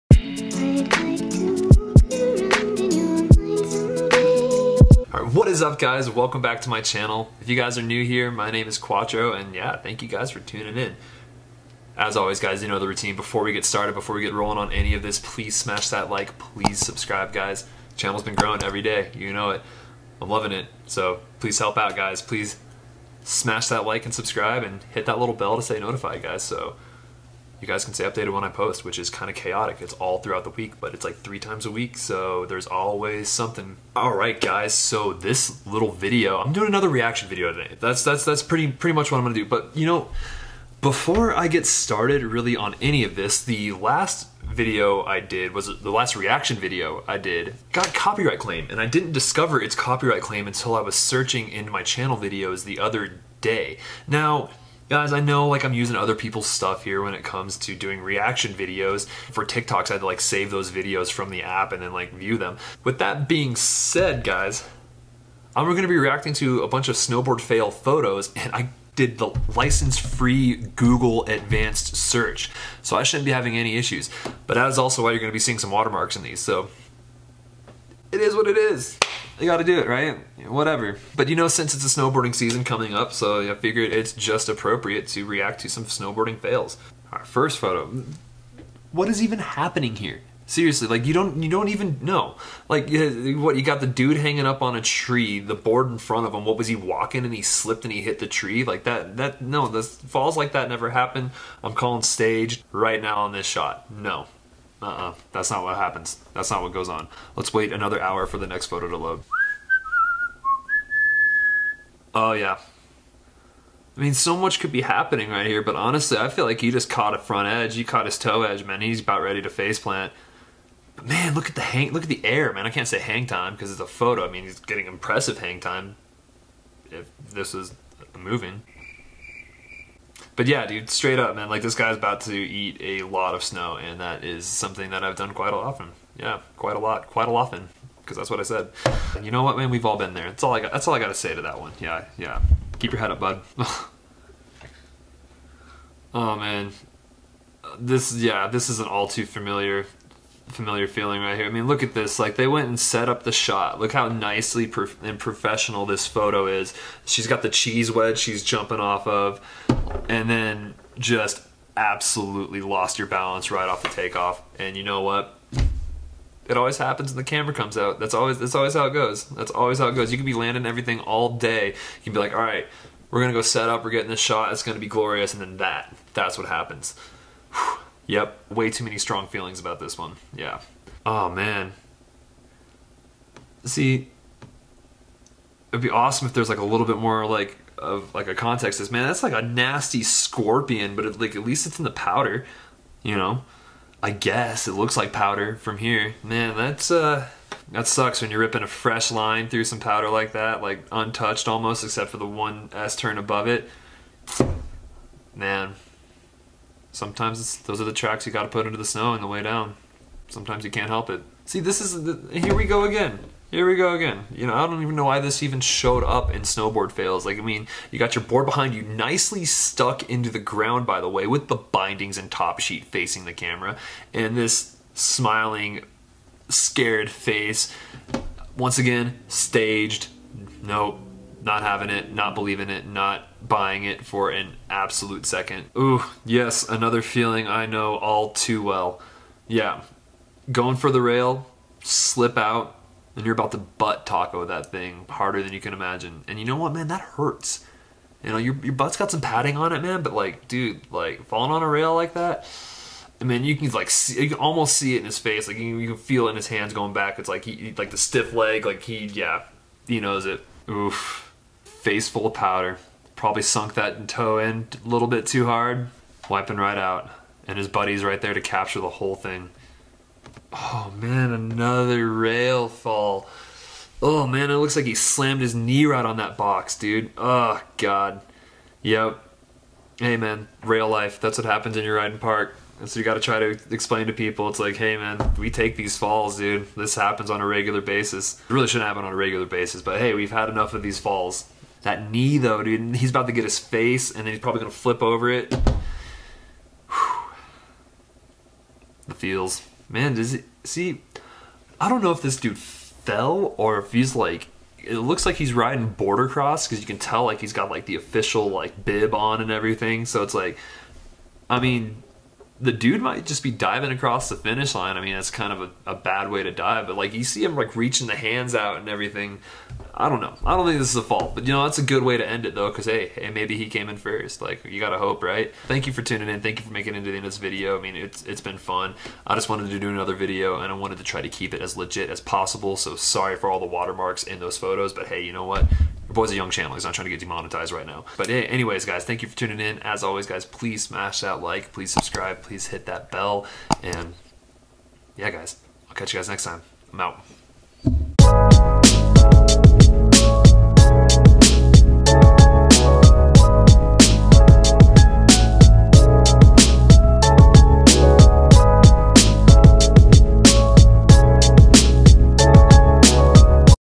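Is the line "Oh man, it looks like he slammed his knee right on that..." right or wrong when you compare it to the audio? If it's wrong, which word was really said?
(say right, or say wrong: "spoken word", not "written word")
right.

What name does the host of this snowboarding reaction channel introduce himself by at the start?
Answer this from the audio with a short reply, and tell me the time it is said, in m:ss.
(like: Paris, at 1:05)
Quattro, at 0:08.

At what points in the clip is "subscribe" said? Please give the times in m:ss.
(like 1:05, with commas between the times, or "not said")
0:16, 0:24, 5:41.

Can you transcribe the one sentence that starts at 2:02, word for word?
I can't say hang time because it's a photo.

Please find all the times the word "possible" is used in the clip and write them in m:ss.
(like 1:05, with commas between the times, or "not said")
5:32.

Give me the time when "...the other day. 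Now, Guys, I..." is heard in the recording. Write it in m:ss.
0:52.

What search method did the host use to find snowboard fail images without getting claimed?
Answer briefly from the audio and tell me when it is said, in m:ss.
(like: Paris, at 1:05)
license free Google advanced search, at 1:09.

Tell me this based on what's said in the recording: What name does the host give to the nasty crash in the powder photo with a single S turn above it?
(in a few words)
scorpion.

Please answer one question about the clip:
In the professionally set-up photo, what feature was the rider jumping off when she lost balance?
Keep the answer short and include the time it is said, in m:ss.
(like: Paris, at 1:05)
cheese wedge, at 2:37.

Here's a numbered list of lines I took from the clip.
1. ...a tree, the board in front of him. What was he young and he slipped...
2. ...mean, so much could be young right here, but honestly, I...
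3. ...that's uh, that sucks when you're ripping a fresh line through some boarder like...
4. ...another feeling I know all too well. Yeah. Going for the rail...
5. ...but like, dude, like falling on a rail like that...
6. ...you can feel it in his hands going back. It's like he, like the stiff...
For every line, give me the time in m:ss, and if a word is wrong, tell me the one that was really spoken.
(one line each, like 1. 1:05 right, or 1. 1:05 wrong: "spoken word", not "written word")
1. 1:34 wrong: "walking", not "young"
2. 1:54 wrong: "happening", not "young"
3. 3:16 wrong: "powder", not "boarder"
4. 3:56 right
5. 4:10 right
6. 4:15 right.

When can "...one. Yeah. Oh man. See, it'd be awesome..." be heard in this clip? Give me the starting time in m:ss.
2:59.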